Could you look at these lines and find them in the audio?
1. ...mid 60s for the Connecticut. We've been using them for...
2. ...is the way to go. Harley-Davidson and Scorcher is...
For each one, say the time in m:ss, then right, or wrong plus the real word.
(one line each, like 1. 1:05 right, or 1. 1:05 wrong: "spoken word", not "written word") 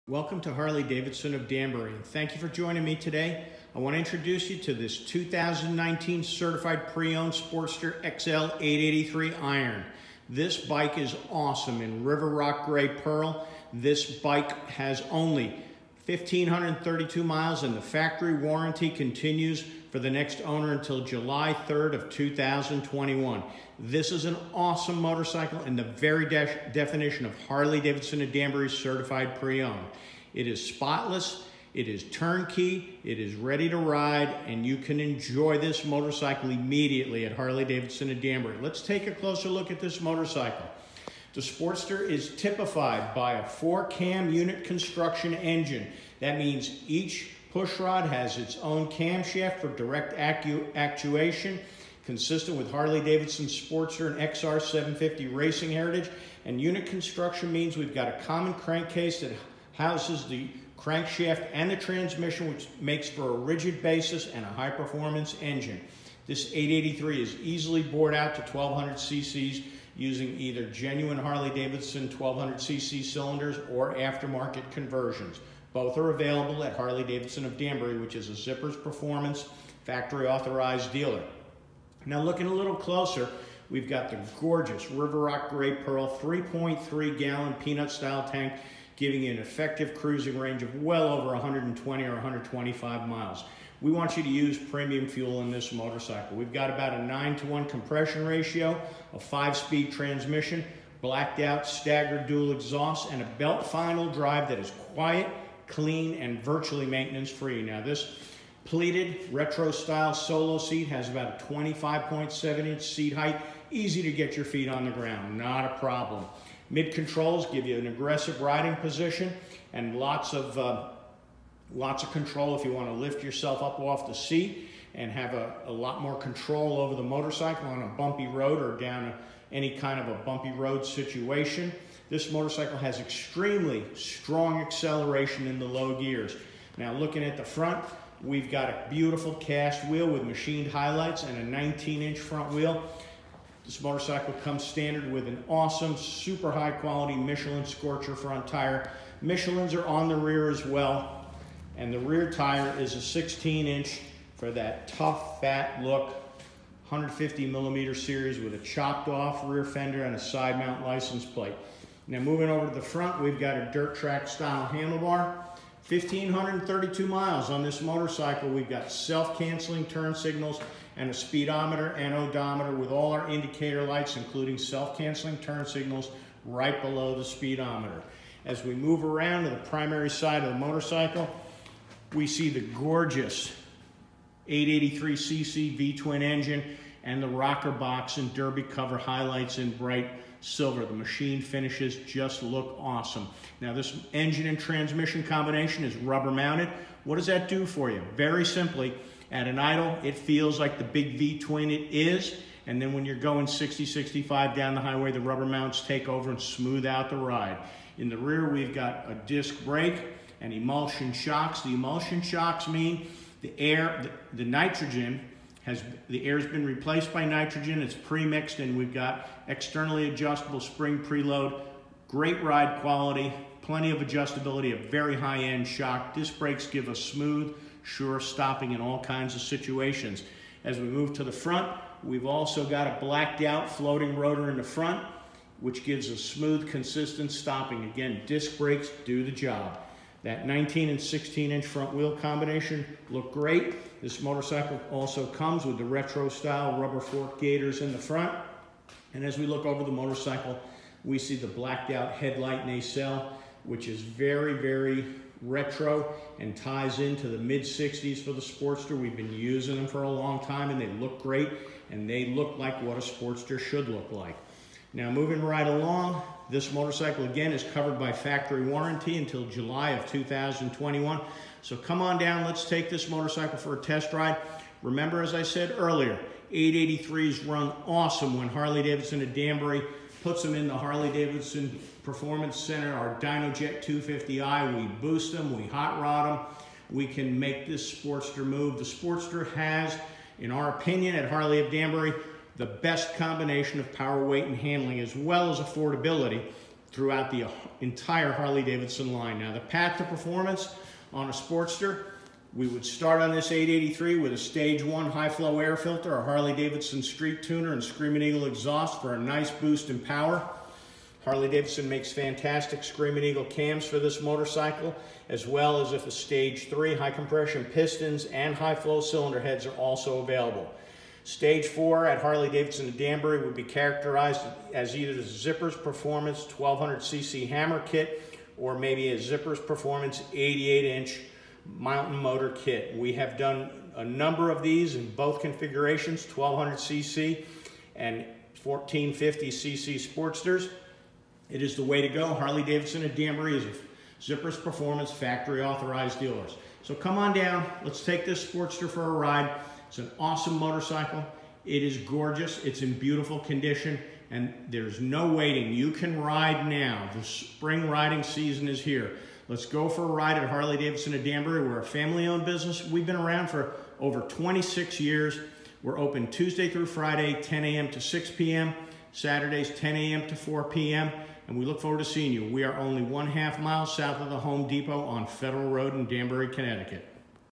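1. 4:17 wrong: "Sportster", not "Connecticut"
2. 5:41 wrong: "Danbury", not "Scorcher".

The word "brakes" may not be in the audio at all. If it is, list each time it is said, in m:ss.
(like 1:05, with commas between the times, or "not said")
3:29, 3:46, 3:58.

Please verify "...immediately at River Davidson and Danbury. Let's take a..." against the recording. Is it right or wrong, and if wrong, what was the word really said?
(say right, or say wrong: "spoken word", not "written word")
wrong: "Harley", not "River".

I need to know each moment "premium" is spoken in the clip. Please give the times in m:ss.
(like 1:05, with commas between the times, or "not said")
1:34.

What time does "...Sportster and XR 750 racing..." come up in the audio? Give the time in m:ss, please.
0:53.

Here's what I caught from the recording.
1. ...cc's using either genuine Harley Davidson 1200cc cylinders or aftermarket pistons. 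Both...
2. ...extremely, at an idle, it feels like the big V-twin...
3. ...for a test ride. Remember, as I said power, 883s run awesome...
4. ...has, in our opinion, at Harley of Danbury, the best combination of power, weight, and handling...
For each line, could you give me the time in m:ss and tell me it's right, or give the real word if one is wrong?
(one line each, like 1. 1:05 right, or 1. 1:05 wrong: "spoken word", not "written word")
1. 1:08 wrong: "conversions", not "pistons"
2. 3:18 wrong: "simply", not "extremely"
3. 4:33 wrong: "earlier", not "power"
4. 4:49 right.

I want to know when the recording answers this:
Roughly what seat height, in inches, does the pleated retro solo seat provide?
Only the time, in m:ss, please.
1:51.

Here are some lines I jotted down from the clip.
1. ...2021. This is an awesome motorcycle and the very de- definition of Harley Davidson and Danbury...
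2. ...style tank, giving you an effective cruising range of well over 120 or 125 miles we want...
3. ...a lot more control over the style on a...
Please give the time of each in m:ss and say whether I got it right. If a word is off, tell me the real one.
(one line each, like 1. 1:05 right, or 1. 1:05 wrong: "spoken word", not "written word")
1. 0:22 right
2. 1:27 right
3. 2:05 wrong: "motorcycle", not "style".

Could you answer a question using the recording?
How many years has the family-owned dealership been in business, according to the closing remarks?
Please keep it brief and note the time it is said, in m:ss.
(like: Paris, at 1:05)
over 26 years, at 6:03.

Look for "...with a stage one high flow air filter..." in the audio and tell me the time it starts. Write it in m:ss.
5:04.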